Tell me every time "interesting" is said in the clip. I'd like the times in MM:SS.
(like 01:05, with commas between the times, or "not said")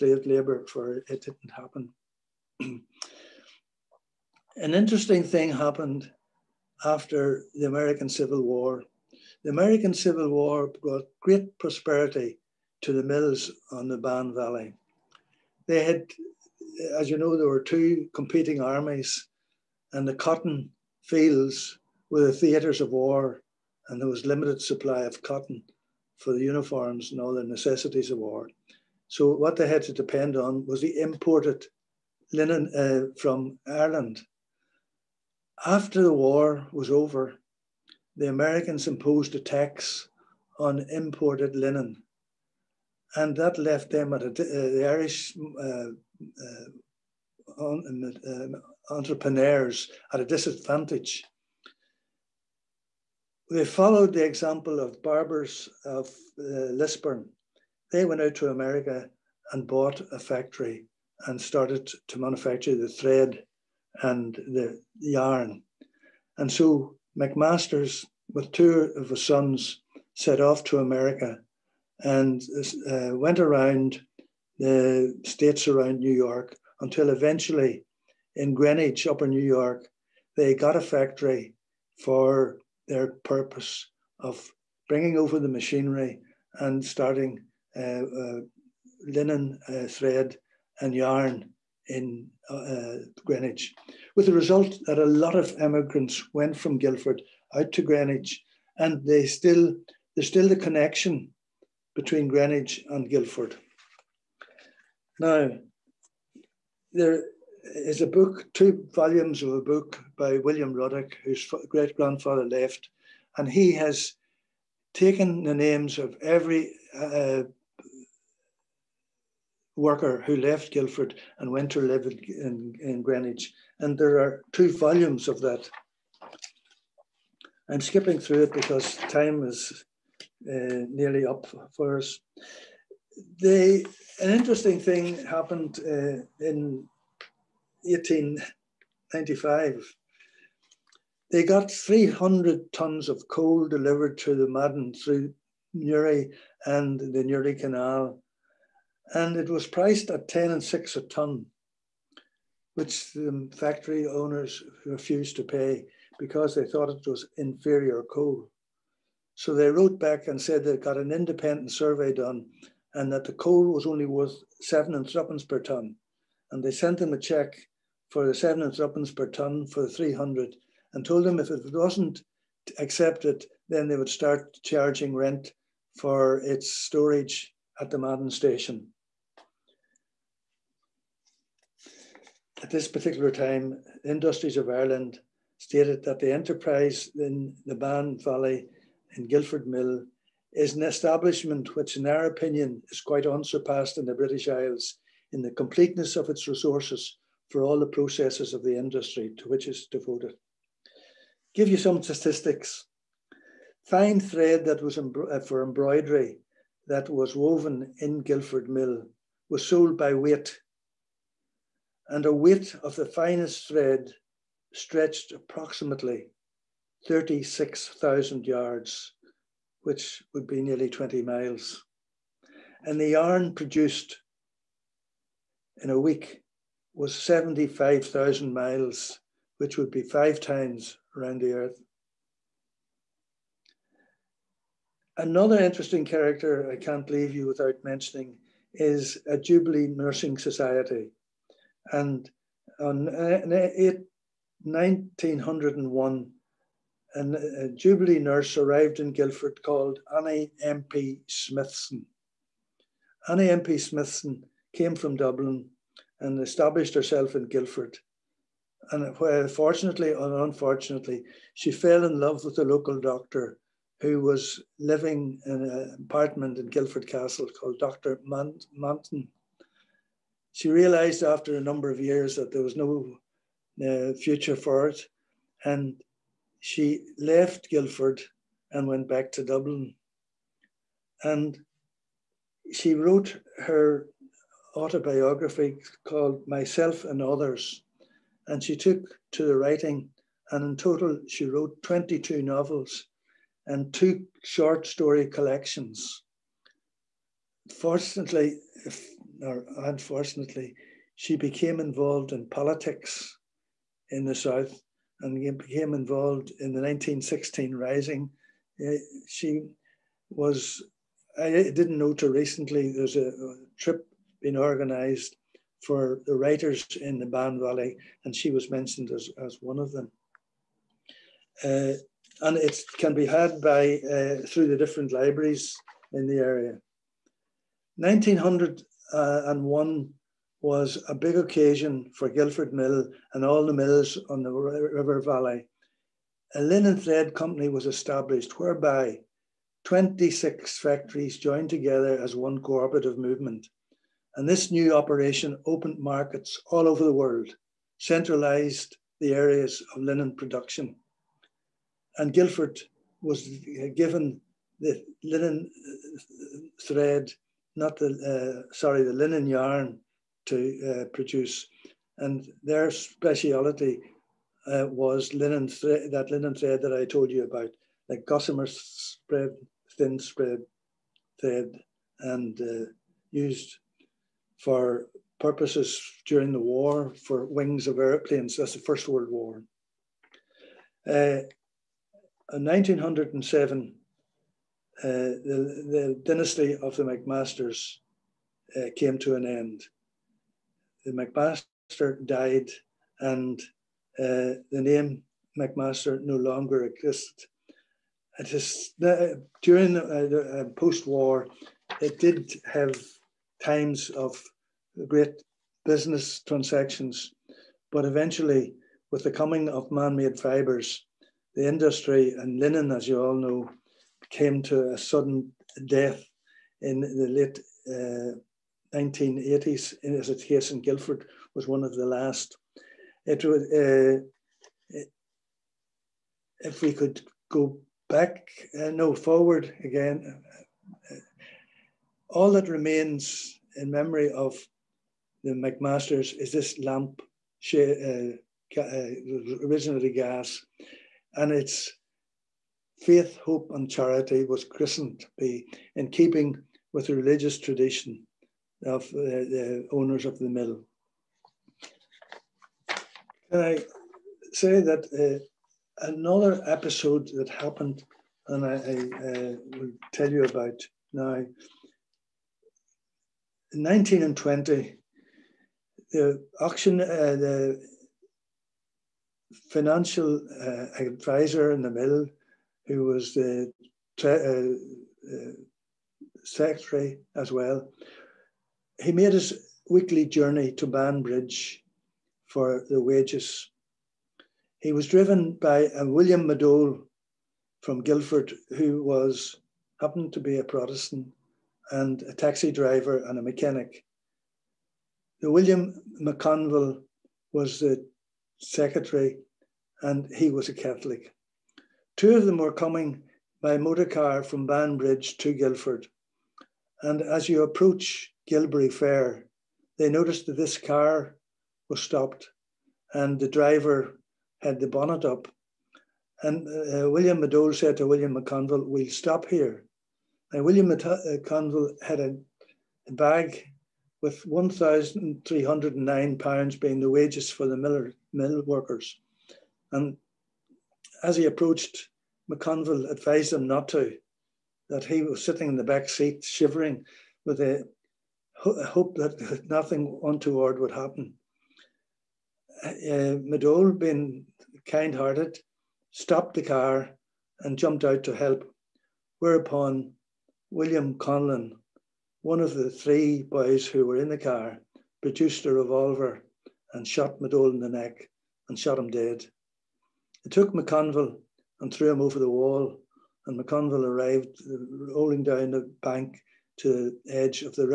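00:04, 02:14, 03:55.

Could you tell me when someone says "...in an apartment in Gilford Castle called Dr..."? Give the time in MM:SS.
04:25.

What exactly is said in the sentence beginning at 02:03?
And there are two volumes of that.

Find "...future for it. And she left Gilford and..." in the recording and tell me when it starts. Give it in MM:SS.
04:34.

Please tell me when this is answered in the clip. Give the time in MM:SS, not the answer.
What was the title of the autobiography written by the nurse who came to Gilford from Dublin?
04:46.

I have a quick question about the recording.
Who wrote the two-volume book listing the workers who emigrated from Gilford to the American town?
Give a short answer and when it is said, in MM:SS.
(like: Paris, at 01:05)
William Ruddock, at 01:50.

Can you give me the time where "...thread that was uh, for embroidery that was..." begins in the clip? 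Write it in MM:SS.
03:24.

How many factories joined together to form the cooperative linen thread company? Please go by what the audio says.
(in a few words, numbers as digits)
26.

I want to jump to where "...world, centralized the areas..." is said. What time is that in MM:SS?
05:47.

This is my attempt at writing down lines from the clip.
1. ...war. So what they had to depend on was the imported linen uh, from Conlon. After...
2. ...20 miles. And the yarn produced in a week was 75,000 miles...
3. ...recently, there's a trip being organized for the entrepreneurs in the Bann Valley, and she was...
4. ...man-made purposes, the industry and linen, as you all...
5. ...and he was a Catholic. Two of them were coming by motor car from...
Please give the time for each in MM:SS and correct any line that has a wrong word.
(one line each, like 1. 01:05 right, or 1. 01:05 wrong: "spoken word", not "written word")
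1. 00:28 wrong: "Ireland", not "Conlon"
2. 03:40 right
3. 05:12 wrong: "writers", not "entrepreneurs"
4. 06:49 wrong: "fibres", not "purposes"
5. 08:20 right.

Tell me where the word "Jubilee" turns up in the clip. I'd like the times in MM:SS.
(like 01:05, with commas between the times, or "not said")
03:59, 04:07.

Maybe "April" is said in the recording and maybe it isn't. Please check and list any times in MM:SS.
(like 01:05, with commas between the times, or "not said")
not said.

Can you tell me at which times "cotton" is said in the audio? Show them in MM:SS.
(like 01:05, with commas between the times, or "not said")
00:20, 00:25.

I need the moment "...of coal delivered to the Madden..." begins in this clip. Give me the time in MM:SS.
02:23.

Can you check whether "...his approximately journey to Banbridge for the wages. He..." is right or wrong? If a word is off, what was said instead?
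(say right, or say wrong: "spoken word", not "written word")
wrong: "weekly", not "approximately".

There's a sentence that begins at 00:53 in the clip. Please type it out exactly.
They followed the example of Barbours of Lisburn.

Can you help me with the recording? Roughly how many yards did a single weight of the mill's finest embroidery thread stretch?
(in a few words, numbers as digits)
36,000.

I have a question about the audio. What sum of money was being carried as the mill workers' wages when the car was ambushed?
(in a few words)
£1,309.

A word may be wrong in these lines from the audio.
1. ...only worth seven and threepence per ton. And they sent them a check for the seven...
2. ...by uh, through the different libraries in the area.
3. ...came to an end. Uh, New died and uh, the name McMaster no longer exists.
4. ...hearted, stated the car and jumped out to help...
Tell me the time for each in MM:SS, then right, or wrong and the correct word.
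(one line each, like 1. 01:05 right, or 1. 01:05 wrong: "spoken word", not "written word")
1. 02:43 right
2. 05:23 right
3. 06:28 wrong: "McMaster", not "New"
4. 09:05 wrong: "stopped", not "stated".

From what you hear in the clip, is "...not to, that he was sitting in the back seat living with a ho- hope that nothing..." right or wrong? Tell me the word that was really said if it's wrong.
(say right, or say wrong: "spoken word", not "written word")
wrong: "shivering", not "living".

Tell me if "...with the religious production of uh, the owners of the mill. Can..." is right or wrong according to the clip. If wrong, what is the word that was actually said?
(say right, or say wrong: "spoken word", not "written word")
wrong: "tradition", not "production".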